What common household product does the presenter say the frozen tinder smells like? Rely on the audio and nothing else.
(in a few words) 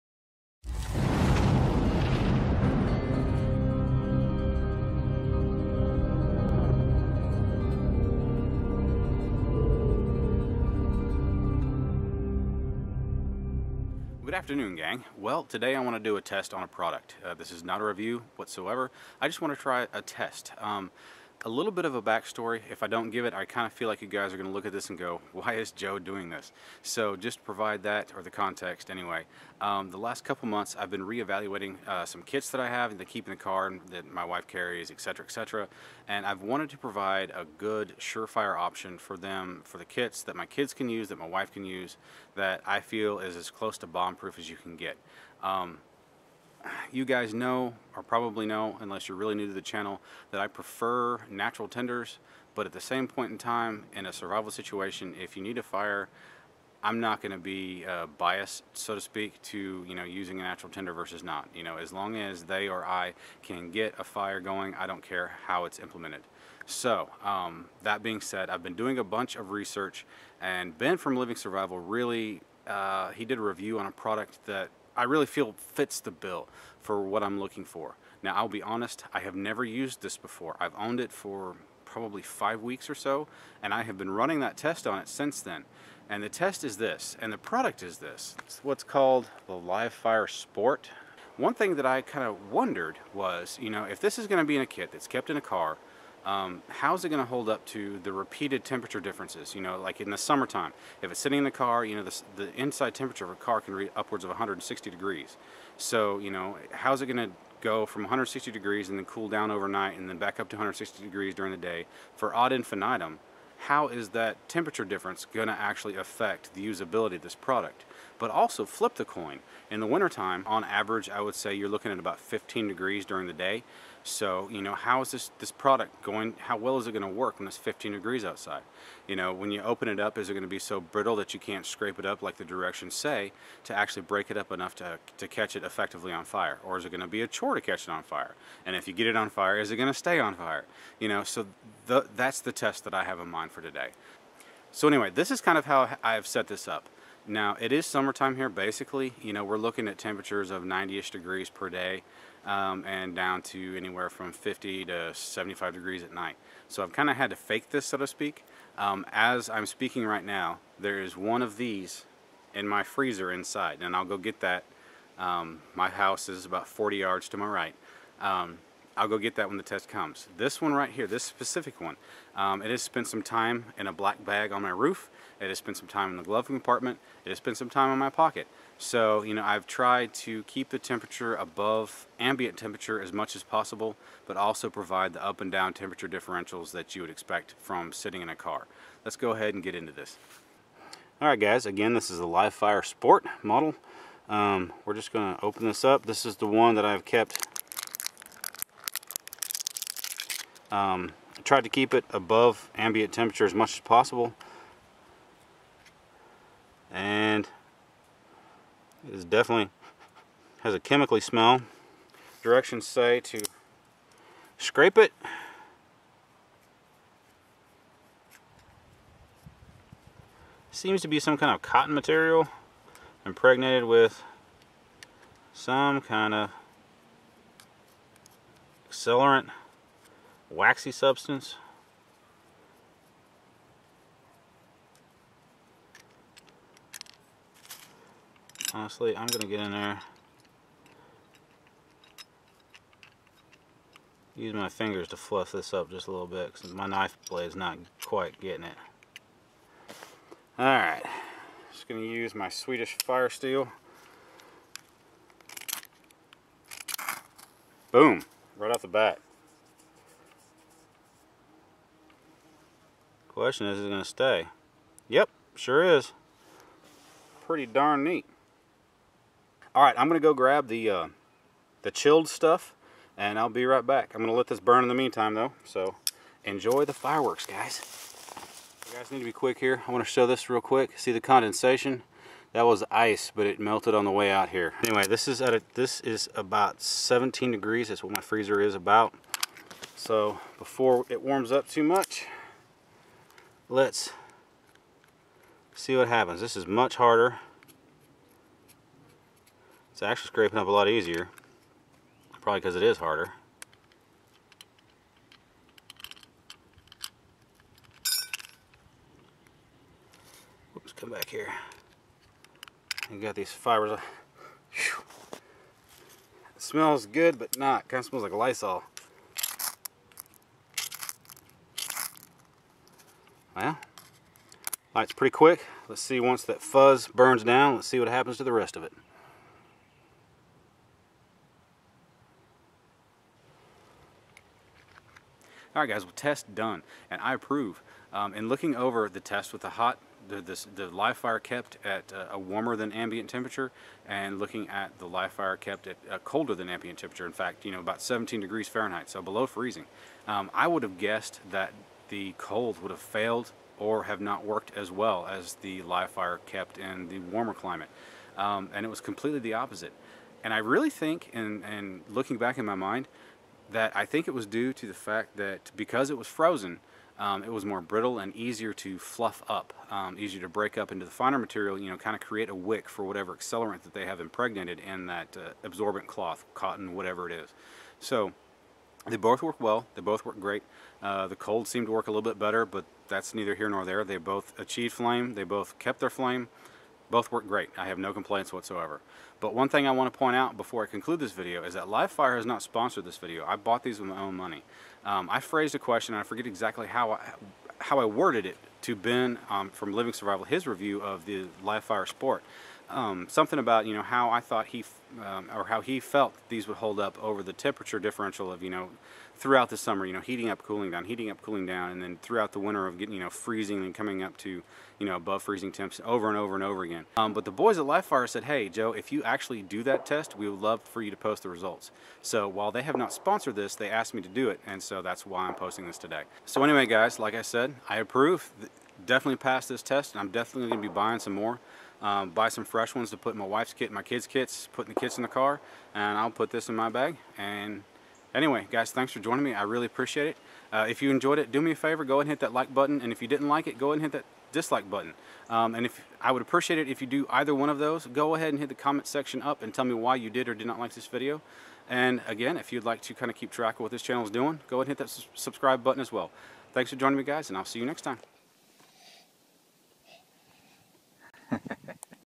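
Lysol.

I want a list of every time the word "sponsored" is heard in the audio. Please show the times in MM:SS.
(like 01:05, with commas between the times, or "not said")
06:32, 07:03.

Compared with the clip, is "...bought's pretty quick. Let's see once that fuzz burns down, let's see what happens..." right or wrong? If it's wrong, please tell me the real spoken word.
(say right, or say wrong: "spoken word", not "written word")
wrong: "light", not "bought".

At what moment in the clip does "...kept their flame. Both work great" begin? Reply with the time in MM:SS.
06:25.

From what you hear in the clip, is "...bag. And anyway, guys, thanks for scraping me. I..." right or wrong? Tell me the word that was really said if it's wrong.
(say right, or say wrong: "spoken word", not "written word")
wrong: "joining", not "scraping".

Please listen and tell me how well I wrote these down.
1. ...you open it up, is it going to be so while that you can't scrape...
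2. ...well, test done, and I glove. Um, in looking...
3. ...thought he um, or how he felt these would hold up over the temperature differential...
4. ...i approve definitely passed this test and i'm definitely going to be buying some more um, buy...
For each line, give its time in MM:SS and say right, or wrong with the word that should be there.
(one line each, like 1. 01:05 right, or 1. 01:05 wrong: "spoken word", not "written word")
1. 02:09 wrong: "brittle", not "while"
2. 05:36 wrong: "approve", not "glove"
3. 06:44 right
4. 07:07 right.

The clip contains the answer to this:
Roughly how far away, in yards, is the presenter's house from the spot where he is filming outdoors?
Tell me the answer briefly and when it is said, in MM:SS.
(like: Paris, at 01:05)
40 yards, at 02:46.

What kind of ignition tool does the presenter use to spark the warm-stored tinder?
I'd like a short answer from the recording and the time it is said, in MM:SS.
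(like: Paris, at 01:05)
Swedish fire steel, at 04:12.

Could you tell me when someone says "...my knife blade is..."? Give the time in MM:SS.
04:06.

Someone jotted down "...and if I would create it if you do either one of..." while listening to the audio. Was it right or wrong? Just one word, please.
wrong.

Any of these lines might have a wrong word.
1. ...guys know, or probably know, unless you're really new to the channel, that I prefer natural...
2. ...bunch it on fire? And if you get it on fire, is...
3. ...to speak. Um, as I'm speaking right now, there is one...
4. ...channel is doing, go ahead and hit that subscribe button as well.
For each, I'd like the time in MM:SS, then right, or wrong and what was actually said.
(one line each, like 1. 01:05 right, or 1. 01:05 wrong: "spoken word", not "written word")
1. 00:47 right
2. 02:17 wrong: "catch", not "bunch"
3. 02:37 right
4. 07:34 right.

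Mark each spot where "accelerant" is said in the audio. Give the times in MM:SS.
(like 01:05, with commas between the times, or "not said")
03:48, 06:13.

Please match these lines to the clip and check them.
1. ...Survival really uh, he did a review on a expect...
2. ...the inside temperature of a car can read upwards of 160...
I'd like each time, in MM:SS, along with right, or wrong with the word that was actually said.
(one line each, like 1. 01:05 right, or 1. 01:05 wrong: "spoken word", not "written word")
1. 01:11 wrong: "product", not "expect"
2. 01:42 right.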